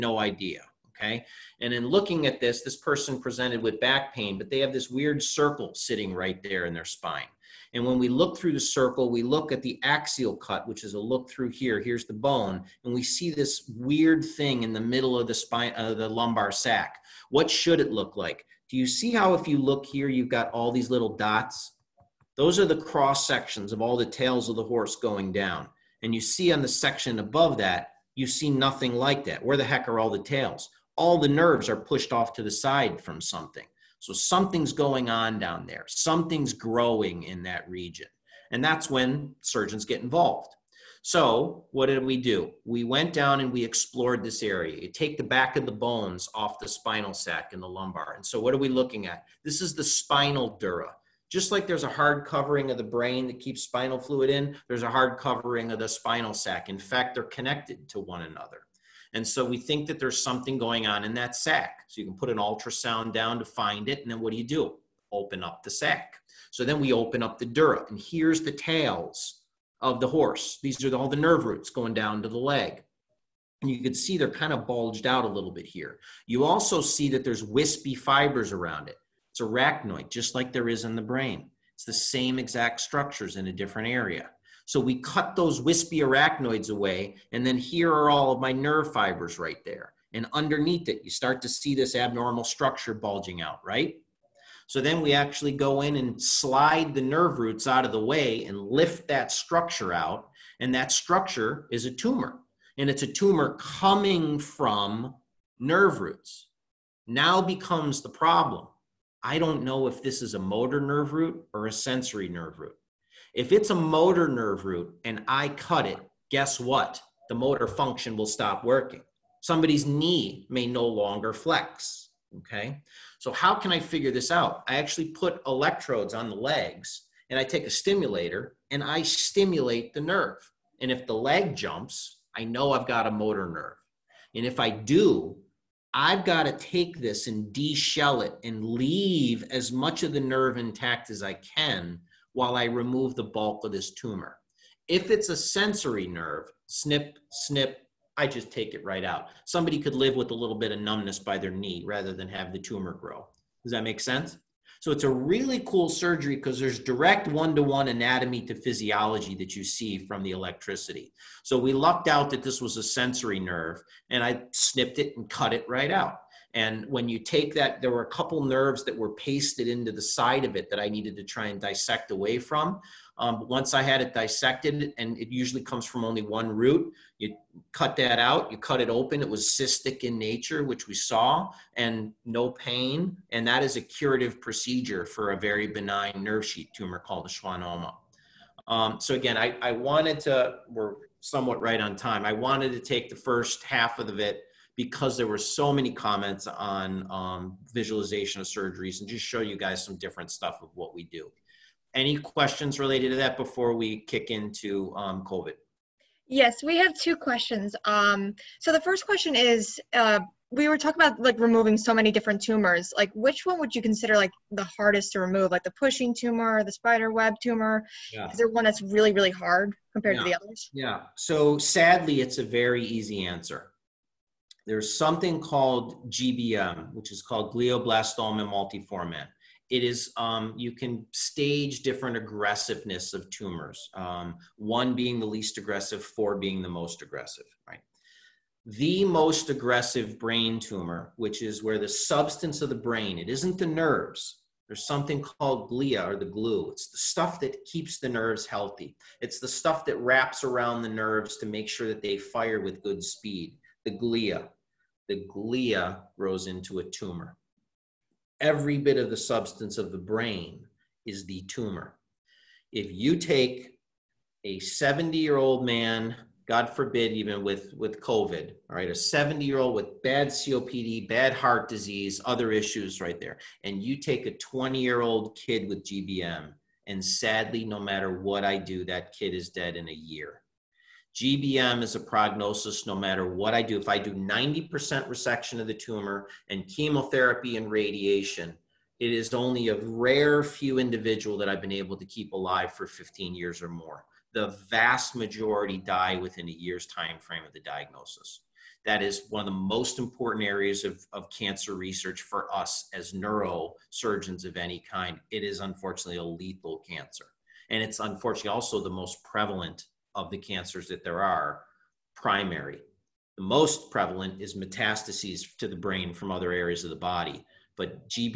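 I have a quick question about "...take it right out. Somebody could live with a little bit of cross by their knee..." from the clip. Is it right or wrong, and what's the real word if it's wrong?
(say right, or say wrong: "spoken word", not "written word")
wrong: "numbness", not "cross".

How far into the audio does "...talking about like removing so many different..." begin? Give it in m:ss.
3:30.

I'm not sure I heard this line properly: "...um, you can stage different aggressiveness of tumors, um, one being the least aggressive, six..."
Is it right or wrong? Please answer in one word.
wrong.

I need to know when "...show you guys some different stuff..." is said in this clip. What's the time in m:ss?
3:19.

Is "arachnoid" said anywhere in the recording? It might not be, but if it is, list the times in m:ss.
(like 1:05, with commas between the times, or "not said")
1:19, 1:26.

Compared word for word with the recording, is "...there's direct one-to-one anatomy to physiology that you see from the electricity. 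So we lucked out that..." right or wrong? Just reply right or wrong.
right.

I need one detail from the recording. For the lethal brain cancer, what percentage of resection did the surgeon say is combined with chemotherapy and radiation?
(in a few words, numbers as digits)
90%.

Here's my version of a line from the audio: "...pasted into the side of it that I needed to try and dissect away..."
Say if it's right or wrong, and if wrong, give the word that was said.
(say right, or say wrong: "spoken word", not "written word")
right.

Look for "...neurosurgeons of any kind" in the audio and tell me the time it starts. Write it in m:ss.
5:03.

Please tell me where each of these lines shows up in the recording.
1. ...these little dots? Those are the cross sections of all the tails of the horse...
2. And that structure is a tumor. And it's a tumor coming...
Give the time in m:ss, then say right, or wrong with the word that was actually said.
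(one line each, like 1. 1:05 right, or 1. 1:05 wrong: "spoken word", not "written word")
1. 0:20 right
2. 1:40 right.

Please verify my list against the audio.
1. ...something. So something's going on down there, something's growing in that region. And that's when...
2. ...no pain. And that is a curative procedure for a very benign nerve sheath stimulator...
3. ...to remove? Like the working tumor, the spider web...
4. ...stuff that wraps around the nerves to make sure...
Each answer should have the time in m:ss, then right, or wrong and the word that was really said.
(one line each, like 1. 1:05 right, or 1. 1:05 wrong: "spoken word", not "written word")
1. 0:33 right
2. 3:02 wrong: "tumor", not "stimulator"
3. 3:35 wrong: "pushing", not "working"
4. 4:09 right.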